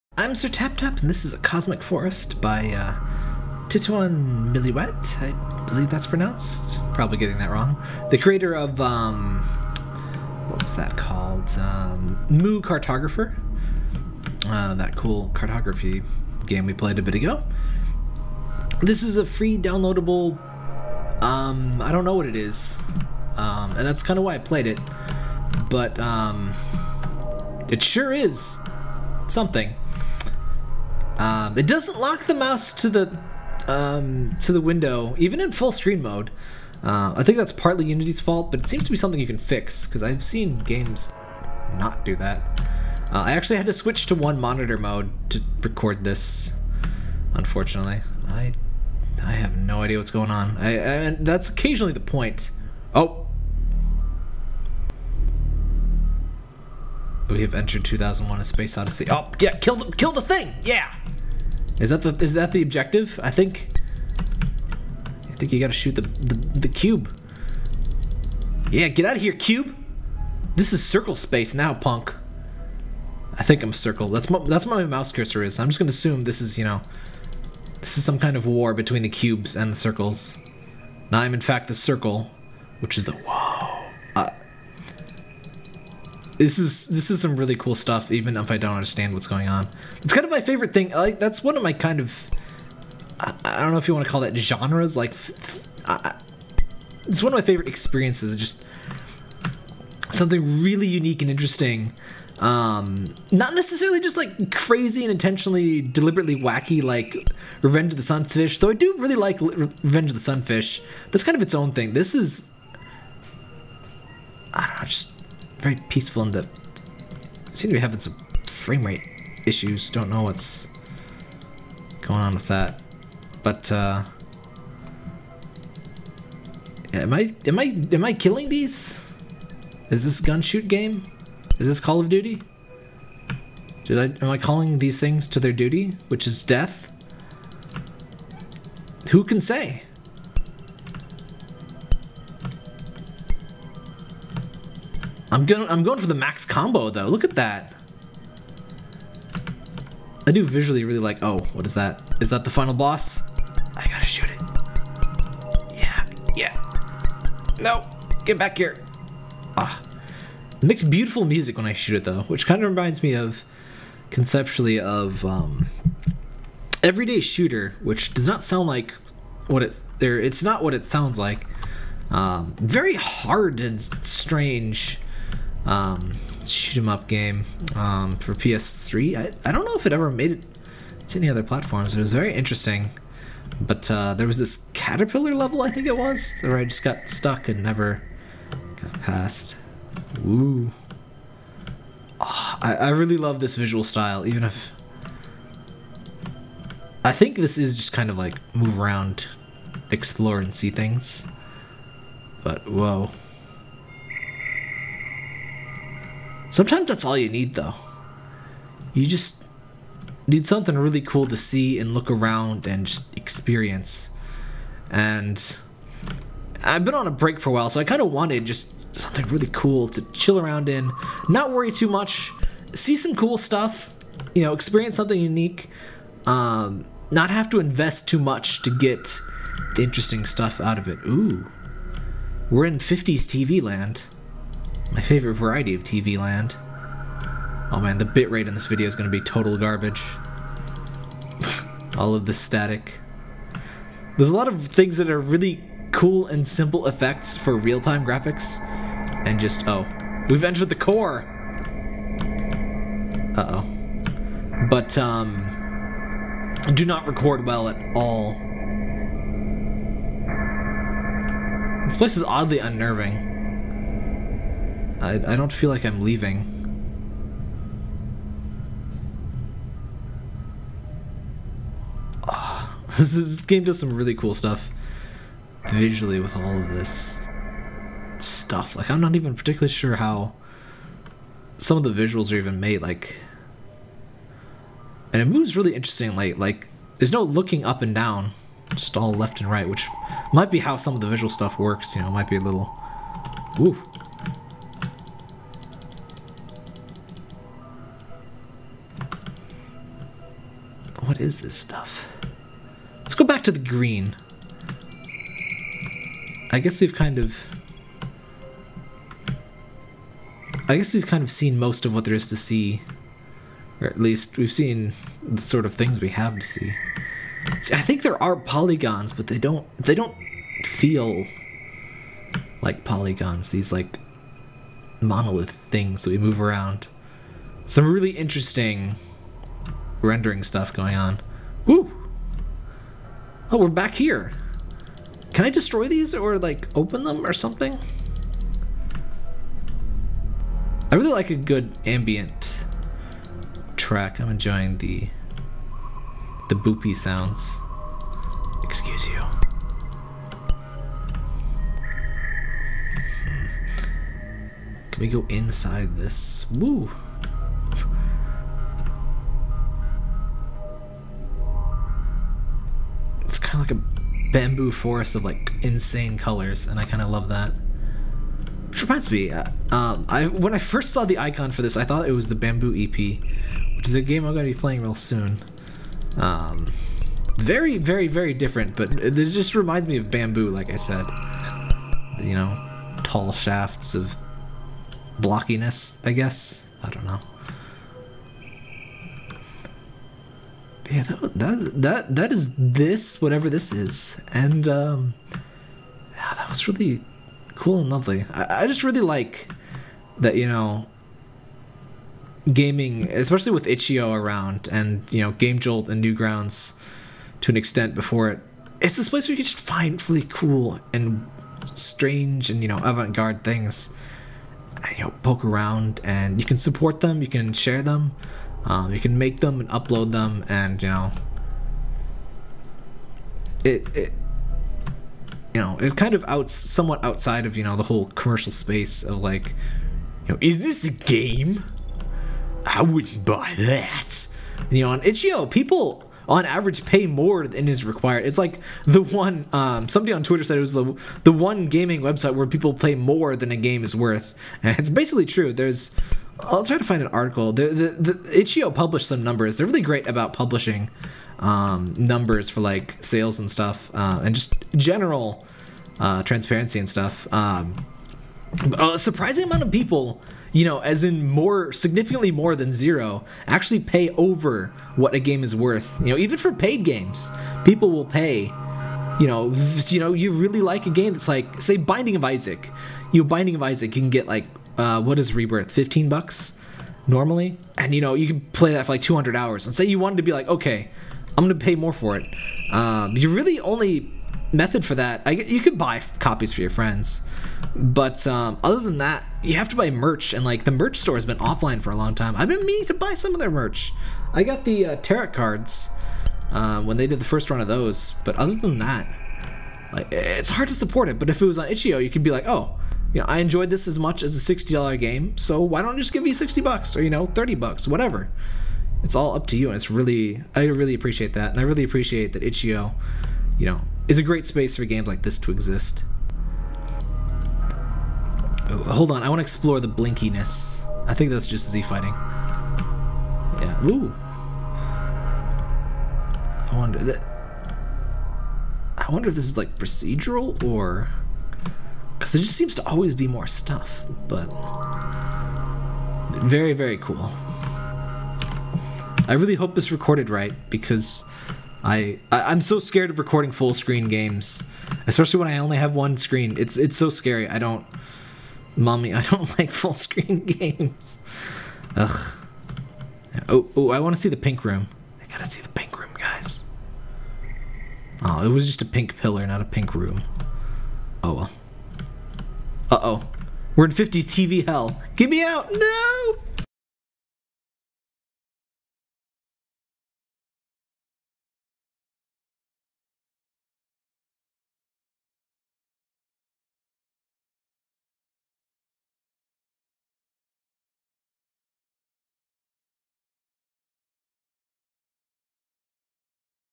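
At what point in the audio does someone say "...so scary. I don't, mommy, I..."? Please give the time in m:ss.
9:06.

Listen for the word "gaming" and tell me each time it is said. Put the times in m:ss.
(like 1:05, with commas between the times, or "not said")
6:42, 7:21.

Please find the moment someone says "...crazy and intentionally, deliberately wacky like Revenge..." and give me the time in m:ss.
1:44.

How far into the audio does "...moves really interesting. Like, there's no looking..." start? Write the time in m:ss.
4:45.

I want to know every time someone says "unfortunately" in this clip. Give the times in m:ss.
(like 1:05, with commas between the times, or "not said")
0:47.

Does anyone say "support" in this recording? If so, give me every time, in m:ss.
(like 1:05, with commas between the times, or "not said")
6:56, 8:20.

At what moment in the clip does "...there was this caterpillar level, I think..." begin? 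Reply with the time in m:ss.
3:04.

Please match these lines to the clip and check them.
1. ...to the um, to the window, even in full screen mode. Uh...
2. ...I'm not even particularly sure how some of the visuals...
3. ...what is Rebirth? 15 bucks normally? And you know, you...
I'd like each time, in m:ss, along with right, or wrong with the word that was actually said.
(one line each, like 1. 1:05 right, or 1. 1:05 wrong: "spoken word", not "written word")
1. 0:32 right
2. 4:38 right
3. 7:54 right.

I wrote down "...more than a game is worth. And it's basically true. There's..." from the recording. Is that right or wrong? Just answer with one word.
right.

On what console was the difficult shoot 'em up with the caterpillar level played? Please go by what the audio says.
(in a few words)
PS3.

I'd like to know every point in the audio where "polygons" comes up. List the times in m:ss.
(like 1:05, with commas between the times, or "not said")
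5:18, 5:22.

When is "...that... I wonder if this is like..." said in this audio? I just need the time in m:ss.
8:46.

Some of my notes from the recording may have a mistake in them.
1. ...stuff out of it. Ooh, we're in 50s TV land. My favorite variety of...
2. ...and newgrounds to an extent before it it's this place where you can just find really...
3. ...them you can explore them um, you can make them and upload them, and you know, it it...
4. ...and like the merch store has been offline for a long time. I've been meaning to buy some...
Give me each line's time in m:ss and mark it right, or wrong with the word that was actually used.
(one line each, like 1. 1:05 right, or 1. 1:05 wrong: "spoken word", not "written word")
1. 3:50 right
2. 6:45 right
3. 6:56 wrong: "share", not "explore"
4. 8:10 right.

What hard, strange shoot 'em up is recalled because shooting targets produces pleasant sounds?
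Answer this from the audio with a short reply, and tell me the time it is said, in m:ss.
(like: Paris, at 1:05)
Everyday Shooter, at 2:46.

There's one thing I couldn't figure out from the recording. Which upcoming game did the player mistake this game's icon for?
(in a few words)
The Bamboo EP.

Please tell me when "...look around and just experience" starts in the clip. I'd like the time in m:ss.
3:31.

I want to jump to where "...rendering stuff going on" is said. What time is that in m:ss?
5:30.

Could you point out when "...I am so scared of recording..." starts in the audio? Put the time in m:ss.
9:02.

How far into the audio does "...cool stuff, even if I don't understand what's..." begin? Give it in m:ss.
1:27.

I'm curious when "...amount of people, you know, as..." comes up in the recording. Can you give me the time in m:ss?
7:39.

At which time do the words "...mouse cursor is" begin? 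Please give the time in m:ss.
1:14.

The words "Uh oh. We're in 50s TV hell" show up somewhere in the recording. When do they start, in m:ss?
9:22.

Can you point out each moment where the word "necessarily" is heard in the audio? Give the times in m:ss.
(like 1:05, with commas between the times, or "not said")
1:43.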